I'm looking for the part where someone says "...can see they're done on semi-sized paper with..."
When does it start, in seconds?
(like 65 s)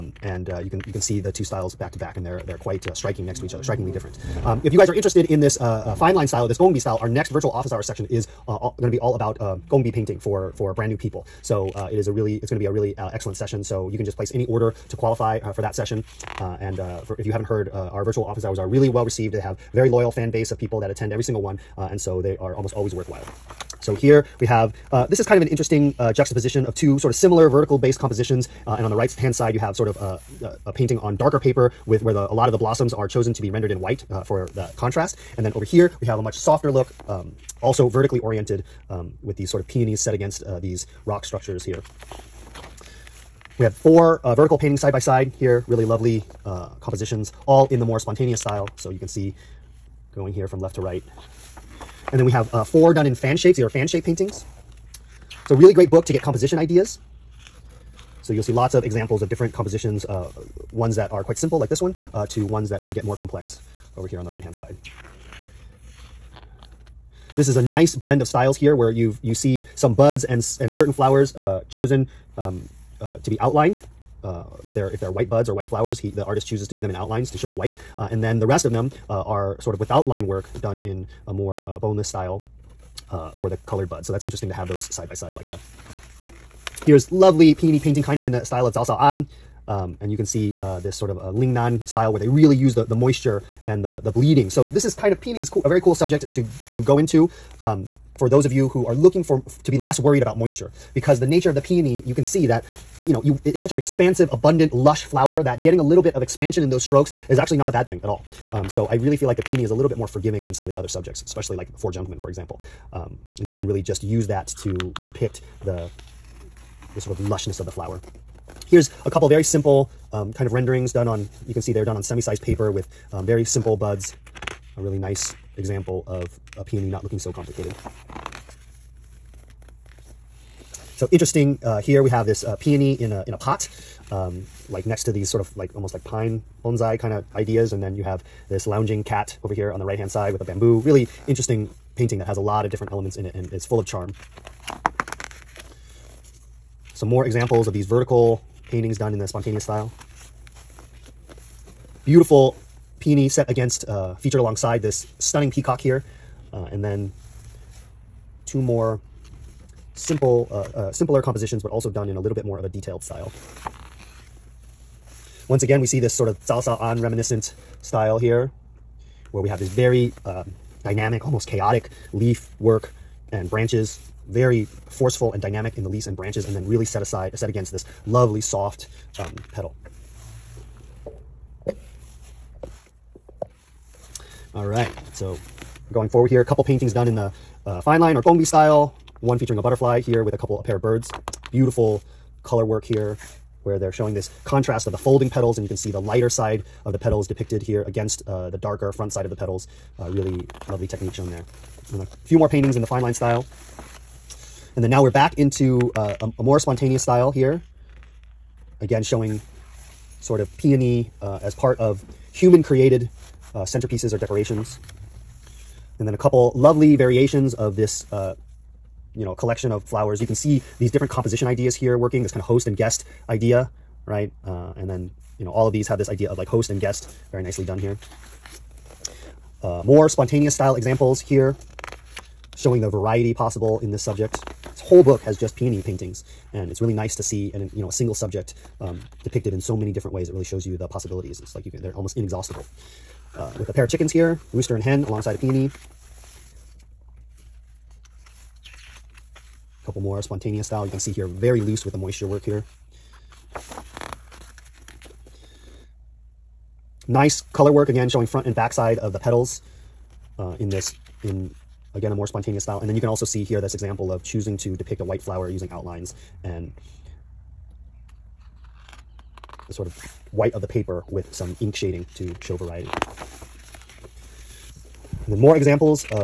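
121 s.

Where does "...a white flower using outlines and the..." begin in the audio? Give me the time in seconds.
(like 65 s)
265 s.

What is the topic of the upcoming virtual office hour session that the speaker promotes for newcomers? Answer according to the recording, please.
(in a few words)
Gongbi painting.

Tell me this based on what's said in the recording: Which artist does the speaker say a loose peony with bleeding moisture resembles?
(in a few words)
Zhao Sao An.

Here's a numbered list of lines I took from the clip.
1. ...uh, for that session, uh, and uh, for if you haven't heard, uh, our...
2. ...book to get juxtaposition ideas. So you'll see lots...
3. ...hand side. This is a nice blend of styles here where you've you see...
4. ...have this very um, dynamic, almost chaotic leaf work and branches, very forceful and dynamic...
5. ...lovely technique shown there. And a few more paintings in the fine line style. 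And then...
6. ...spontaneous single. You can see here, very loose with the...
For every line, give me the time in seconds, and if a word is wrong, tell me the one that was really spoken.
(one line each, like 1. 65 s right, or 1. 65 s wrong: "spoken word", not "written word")
1. 15 s right
2. 55 s wrong: "composition", not "juxtaposition"
3. 64 s right
4. 169 s right
5. 200 s right
6. 250 s wrong: "style", not "single".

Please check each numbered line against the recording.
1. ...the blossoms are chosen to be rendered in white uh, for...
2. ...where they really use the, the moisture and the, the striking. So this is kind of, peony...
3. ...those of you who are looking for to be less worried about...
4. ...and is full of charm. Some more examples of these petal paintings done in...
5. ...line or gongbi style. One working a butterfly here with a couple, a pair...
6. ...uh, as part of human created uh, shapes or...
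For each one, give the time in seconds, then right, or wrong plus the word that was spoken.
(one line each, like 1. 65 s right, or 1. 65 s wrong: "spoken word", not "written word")
1. 32 s right
2. 92 s wrong: "bleeding", not "striking"
3. 98 s right
4. 143 s wrong: "vertical", not "petal"
5. 187 s wrong: "featuring", not "working"
6. 211 s wrong: "centerpieces", not "shapes".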